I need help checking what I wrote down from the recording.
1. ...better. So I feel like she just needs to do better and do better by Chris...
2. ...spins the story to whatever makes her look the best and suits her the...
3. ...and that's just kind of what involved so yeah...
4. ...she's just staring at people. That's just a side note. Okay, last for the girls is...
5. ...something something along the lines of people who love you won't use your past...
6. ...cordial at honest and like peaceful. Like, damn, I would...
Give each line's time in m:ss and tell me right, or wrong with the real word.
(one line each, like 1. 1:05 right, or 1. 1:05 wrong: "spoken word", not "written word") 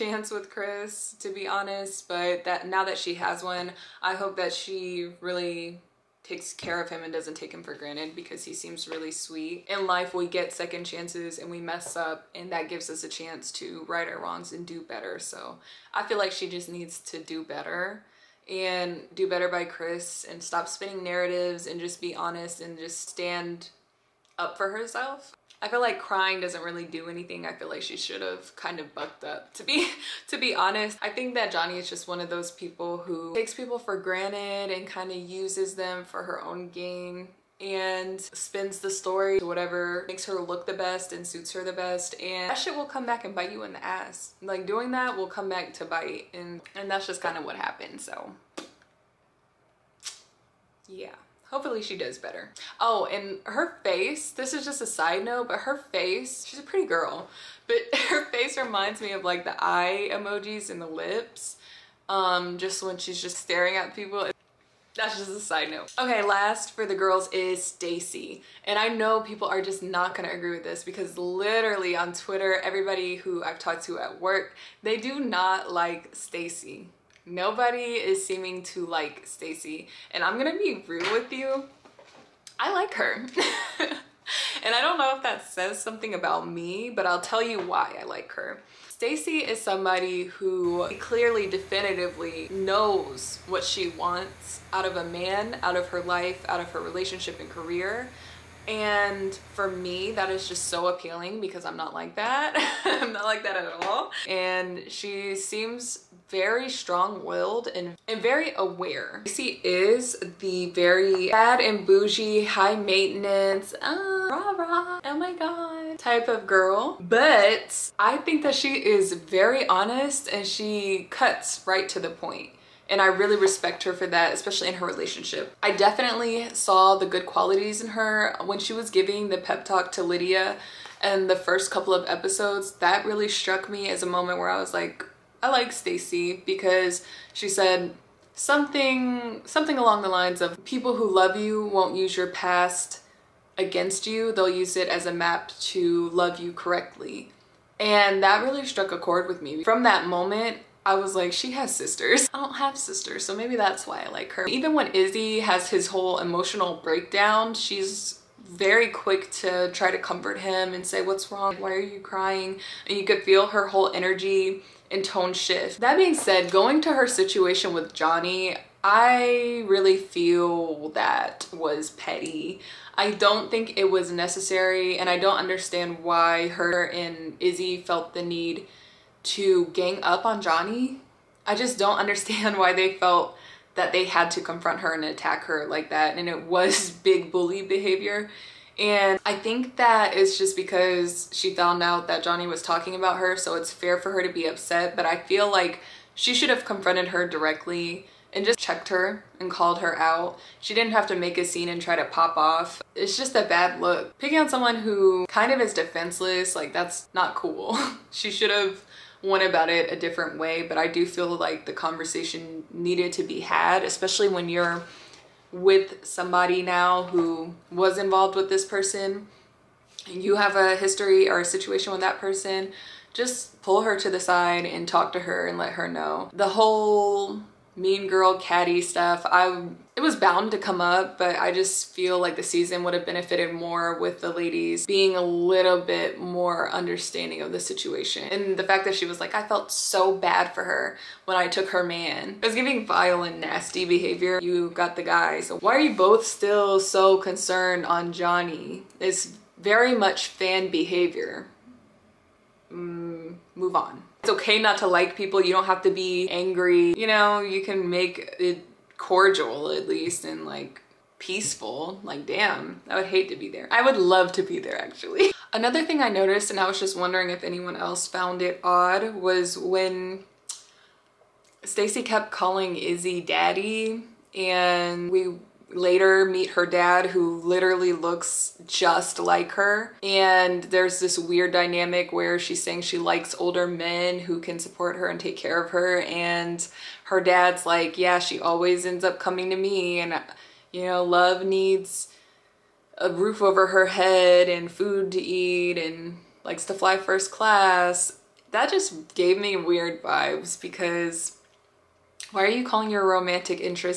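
1. 0:14 right
2. 0:38 right
3. 0:46 wrong: "happened", not "involved"
4. 1:02 right
5. 2:18 right
6. 4:18 wrong: "least", not "honest".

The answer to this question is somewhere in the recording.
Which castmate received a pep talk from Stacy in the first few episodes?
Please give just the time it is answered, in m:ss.
2:10.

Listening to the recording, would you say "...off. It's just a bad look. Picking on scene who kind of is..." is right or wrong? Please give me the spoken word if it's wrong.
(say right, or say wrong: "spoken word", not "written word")
wrong: "someone", not "scene".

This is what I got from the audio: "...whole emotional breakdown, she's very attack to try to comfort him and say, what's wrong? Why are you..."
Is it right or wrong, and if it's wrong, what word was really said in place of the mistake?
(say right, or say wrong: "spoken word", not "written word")
wrong: "quick", not "attack".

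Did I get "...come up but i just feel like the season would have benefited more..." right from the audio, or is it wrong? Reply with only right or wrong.
right.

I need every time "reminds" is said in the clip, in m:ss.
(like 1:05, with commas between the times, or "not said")
0:58.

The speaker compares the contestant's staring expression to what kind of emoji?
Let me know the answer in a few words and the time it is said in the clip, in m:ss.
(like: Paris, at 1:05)
eye emojis, at 0:59.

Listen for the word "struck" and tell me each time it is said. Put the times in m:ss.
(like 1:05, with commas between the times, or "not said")
2:13, 2:28.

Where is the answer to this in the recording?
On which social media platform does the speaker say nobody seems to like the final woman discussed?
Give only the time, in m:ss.
1:12.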